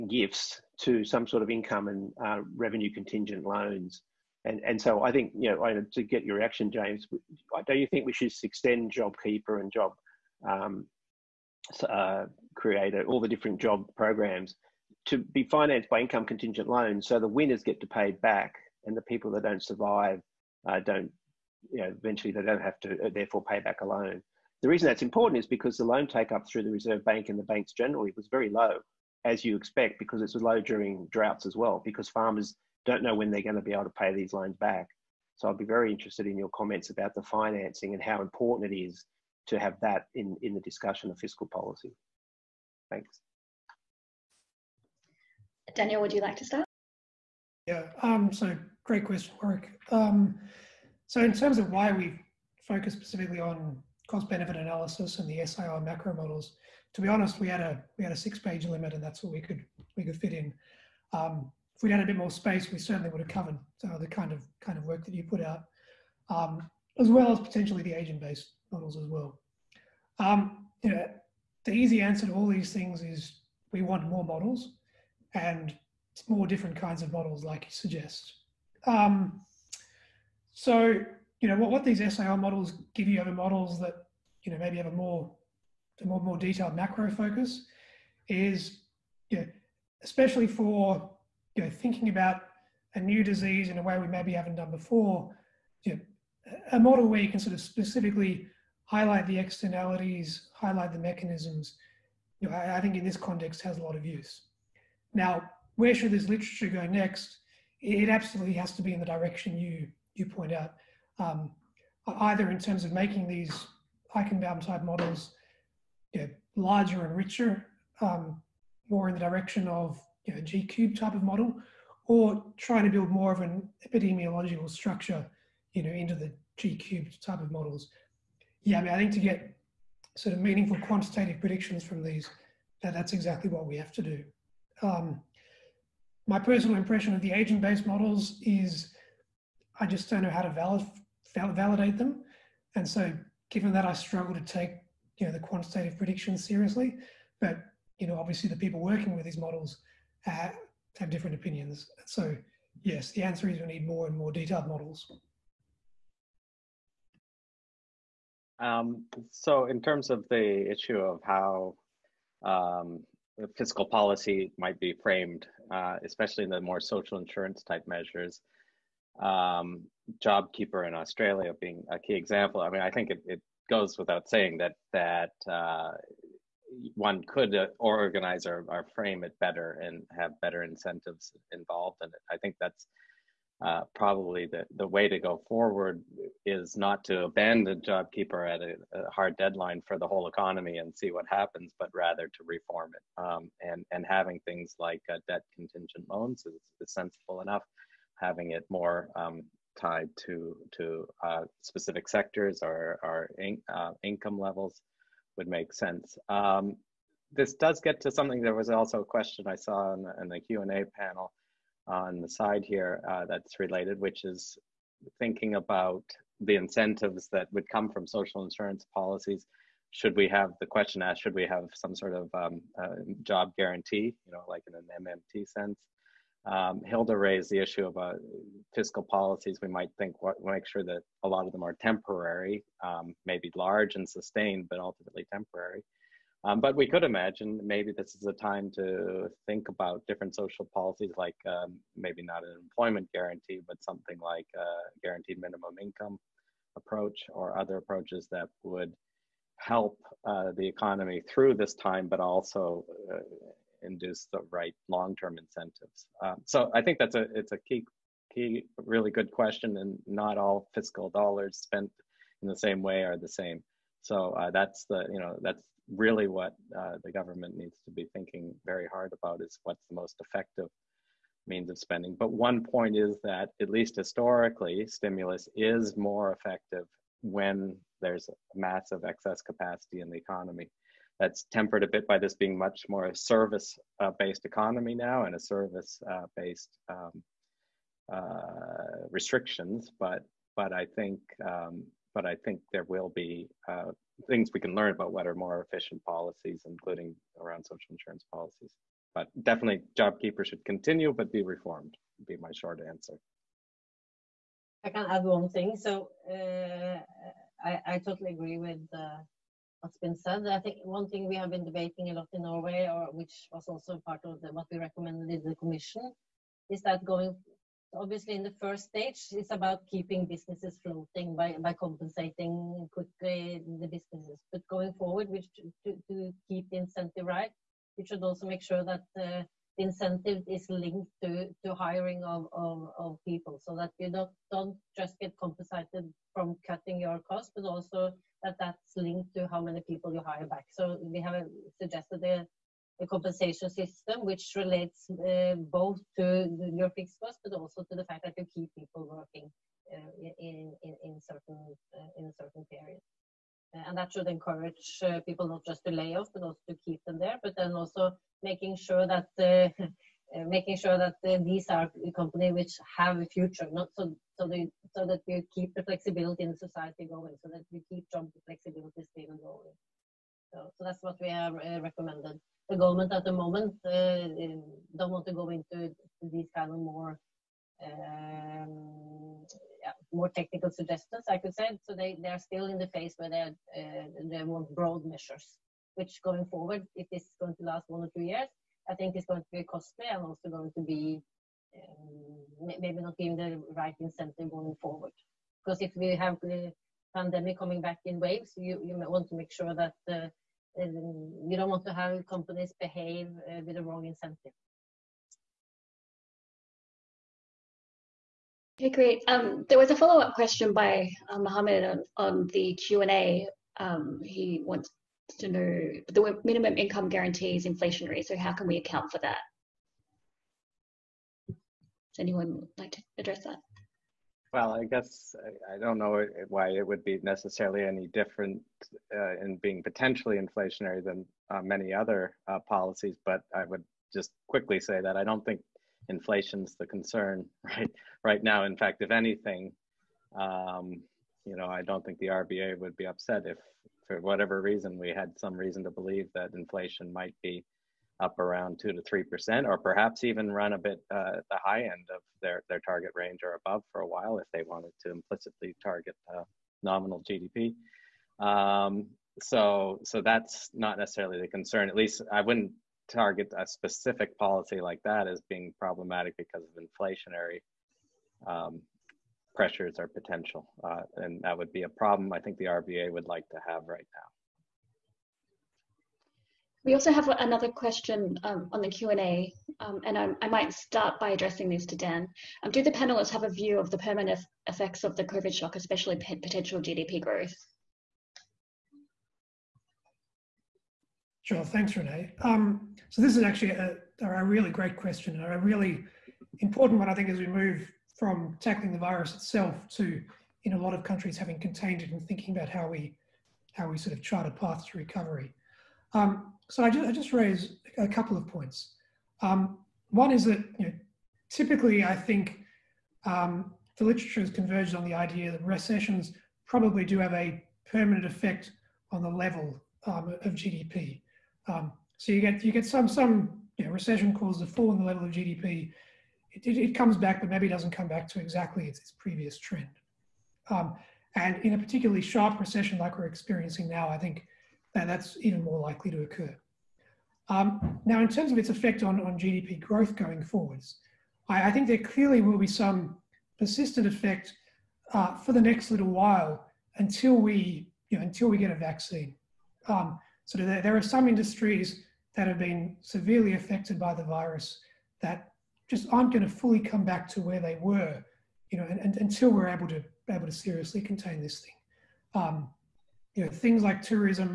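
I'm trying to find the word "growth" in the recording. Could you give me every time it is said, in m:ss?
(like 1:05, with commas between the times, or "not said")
8:07, 8:59.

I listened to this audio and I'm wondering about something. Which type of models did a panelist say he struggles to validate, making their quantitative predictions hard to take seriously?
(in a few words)
Agent-based models.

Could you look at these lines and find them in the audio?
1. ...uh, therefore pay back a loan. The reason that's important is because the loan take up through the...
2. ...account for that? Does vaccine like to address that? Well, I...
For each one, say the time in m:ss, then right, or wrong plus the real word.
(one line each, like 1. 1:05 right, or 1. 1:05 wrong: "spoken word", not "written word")
1. 0:23 right
2. 6:58 wrong: "anyone", not "vaccine".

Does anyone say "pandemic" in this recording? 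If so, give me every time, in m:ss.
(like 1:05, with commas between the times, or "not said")
6:37.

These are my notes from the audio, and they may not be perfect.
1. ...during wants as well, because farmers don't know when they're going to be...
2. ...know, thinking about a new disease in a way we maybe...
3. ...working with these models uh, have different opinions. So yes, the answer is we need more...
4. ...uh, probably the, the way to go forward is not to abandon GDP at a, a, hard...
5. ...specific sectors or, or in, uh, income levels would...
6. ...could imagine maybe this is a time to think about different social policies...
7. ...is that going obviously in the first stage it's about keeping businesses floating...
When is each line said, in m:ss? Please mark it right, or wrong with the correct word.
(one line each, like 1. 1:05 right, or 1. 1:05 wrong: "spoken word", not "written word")
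1. 0:30 wrong: "droughts", not "wants"
2. 1:31 right
3. 2:28 right
4. 3:03 wrong: "JobKeeper", not "GDP"
5. 3:21 right
6. 3:56 right
7. 5:16 right.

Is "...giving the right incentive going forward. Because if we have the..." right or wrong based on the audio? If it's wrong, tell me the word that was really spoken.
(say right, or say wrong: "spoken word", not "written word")
right.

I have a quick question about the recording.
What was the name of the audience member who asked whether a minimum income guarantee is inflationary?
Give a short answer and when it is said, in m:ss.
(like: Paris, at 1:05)
Mohammed, at 6:51.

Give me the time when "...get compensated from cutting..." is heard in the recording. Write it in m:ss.
5:35.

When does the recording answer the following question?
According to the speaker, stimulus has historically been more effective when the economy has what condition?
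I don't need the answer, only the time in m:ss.
4:38.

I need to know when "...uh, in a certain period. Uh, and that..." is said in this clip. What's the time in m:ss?
5:51.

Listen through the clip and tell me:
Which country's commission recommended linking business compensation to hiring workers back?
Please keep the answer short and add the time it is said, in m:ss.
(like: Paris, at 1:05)
Norway, at 5:12.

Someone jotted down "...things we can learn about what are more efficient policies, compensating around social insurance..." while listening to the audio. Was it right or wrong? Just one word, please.
wrong.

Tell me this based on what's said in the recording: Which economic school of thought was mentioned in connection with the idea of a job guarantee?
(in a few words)
MMT.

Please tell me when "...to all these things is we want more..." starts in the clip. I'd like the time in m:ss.
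1:12.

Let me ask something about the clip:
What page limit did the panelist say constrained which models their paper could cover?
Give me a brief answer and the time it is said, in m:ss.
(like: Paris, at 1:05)
6 pages, at 0:58.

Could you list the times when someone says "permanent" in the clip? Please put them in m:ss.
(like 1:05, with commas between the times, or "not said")
8:03, 8:37.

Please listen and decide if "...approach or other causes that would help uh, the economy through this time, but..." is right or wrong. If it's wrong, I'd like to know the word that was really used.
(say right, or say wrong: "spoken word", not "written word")
wrong: "approaches", not "causes".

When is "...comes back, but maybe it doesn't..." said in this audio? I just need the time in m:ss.
8:46.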